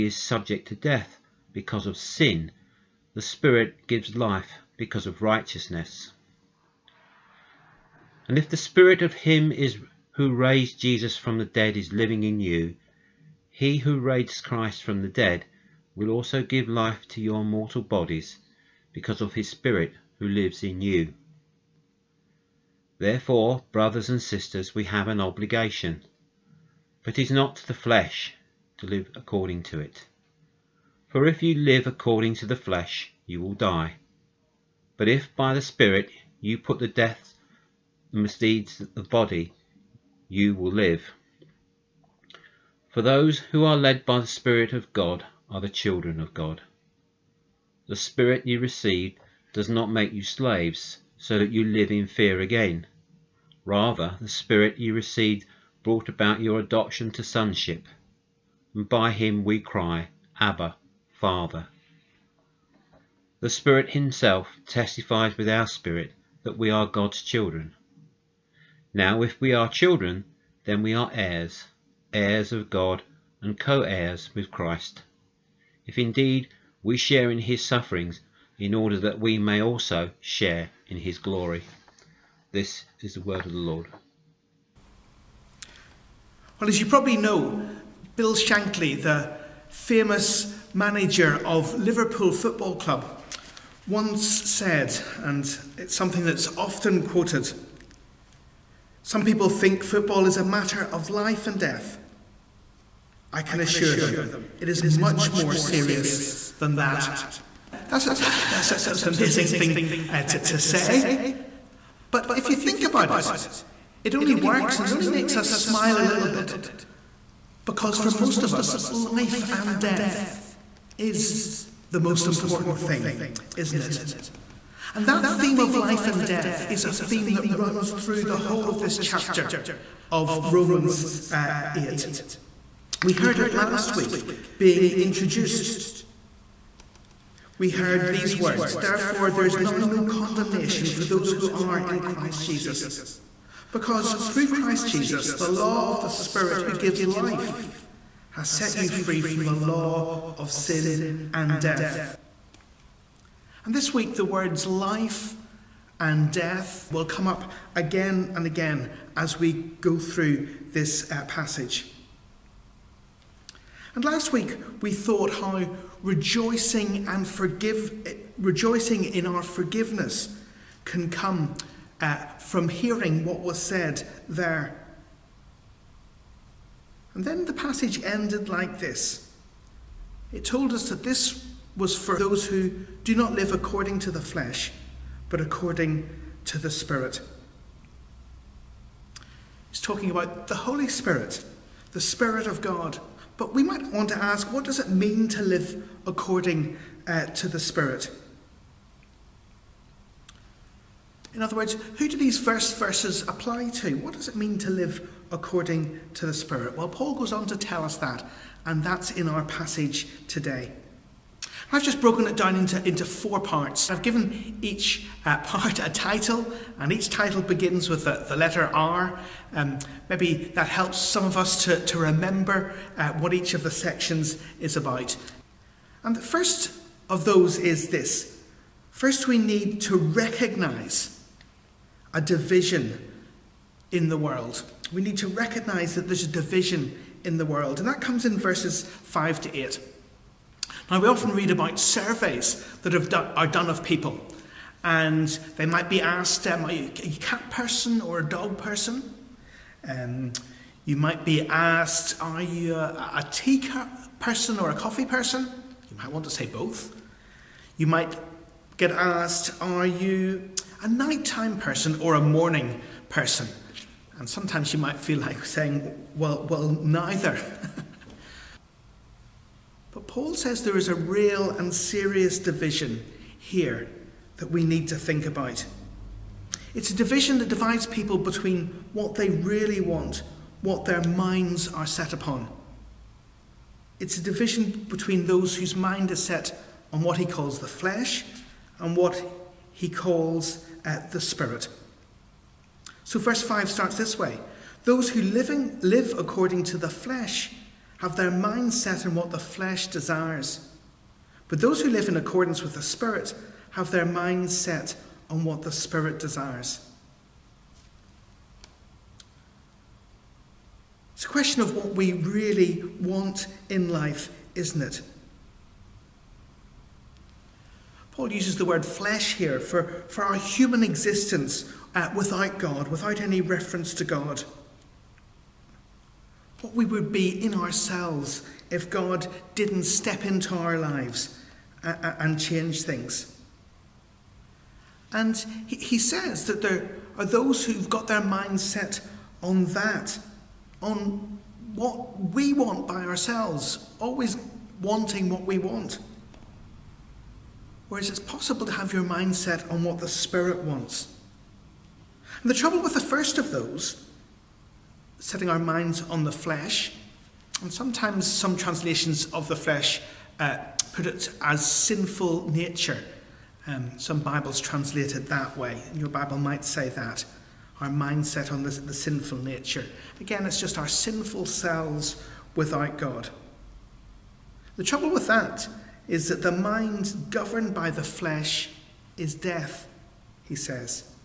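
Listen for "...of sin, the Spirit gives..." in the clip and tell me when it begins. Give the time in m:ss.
0:01.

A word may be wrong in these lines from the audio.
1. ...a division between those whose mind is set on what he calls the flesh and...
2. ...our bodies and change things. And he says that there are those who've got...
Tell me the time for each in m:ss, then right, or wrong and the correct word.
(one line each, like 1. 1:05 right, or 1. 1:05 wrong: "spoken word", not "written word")
1. 4:44 right
2. 5:30 wrong: "lives", not "bodies".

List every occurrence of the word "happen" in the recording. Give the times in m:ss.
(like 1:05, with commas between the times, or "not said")
not said.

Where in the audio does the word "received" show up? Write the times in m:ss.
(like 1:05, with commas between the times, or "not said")
0:48, 0:54.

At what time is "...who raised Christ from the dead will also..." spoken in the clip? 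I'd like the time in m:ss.
0:13.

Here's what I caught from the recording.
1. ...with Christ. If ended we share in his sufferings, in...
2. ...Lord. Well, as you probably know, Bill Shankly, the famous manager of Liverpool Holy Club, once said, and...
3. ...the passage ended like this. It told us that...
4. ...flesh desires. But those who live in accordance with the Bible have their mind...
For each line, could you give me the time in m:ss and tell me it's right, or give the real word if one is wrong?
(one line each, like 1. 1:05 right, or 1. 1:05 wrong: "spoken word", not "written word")
1. 1:14 wrong: "indeed", not "ended"
2. 1:23 wrong: "Football", not "Holy"
3. 2:57 right
4. 4:59 wrong: "Spirit", not "Bible".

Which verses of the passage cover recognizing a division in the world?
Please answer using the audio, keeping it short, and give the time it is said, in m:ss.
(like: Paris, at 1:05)
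5 to 8, at 3:58.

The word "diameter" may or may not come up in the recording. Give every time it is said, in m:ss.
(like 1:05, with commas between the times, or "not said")
not said.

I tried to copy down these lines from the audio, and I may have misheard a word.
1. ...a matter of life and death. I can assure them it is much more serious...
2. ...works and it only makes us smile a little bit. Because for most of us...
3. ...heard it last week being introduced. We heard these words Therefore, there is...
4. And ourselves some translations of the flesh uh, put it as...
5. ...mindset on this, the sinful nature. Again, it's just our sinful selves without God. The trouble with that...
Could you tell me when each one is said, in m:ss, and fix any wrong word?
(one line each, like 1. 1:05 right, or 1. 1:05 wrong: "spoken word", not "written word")
1. 1:40 right
2. 1:54 right
3. 2:13 right
4. 5:57 wrong: "sometimes", not "ourselves"
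5. 6:07 right.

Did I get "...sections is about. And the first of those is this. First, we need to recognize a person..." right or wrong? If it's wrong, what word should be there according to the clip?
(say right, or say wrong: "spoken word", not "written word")
wrong: "division", not "person".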